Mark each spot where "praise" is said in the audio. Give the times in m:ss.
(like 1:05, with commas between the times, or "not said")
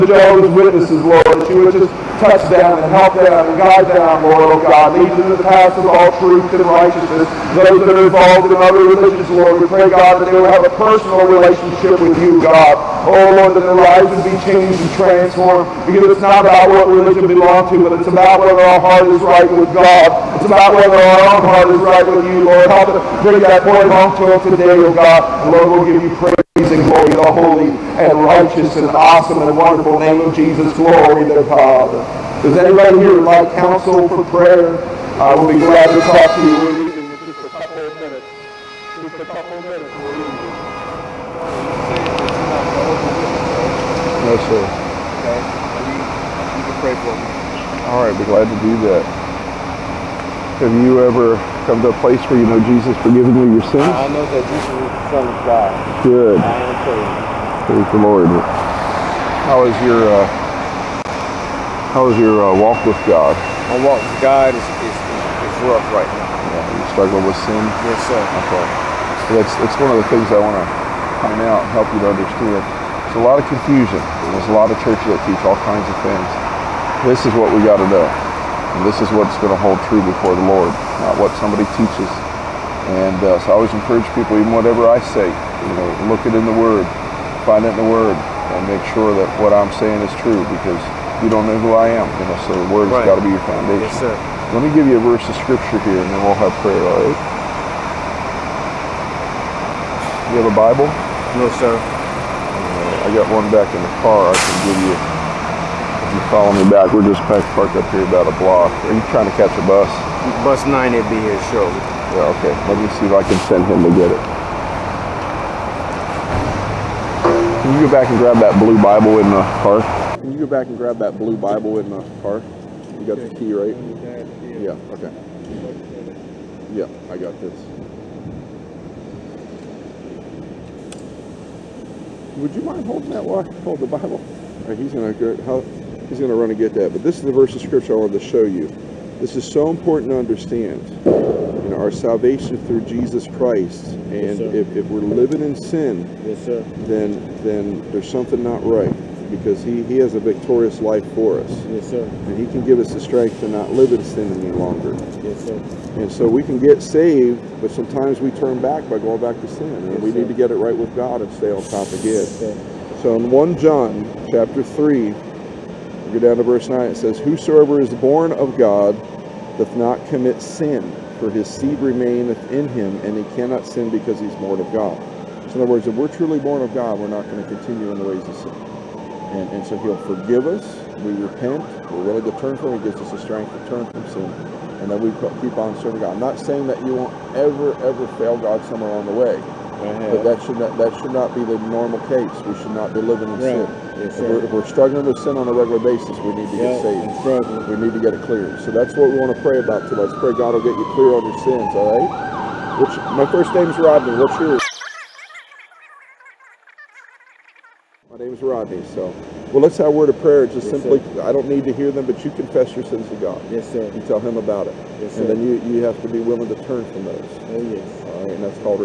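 0:26, 0:57.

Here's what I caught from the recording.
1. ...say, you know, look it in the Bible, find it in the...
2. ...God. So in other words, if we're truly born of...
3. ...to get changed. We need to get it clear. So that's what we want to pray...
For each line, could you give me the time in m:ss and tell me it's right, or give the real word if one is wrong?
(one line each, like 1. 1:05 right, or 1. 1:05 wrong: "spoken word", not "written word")
1. 1:25 wrong: "Word", not "Bible"
2. 2:54 right
3. 3:16 wrong: "saved", not "changed".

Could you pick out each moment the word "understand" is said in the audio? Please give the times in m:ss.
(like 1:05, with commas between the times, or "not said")
1:12, 2:20.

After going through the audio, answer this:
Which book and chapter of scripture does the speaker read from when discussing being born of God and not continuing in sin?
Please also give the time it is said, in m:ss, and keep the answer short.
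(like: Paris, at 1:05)
1 John chapter 3, at 2:43.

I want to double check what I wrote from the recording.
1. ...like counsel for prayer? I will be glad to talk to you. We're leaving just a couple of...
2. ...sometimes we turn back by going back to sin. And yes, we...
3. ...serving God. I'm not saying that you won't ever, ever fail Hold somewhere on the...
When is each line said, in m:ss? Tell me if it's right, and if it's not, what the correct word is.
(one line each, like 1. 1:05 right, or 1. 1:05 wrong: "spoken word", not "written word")
1. 0:33 right
2. 2:37 right
3. 3:05 wrong: "God", not "Hold".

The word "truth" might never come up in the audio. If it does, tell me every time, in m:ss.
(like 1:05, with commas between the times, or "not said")
0:06.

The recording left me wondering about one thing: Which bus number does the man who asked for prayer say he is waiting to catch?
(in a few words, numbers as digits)
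9.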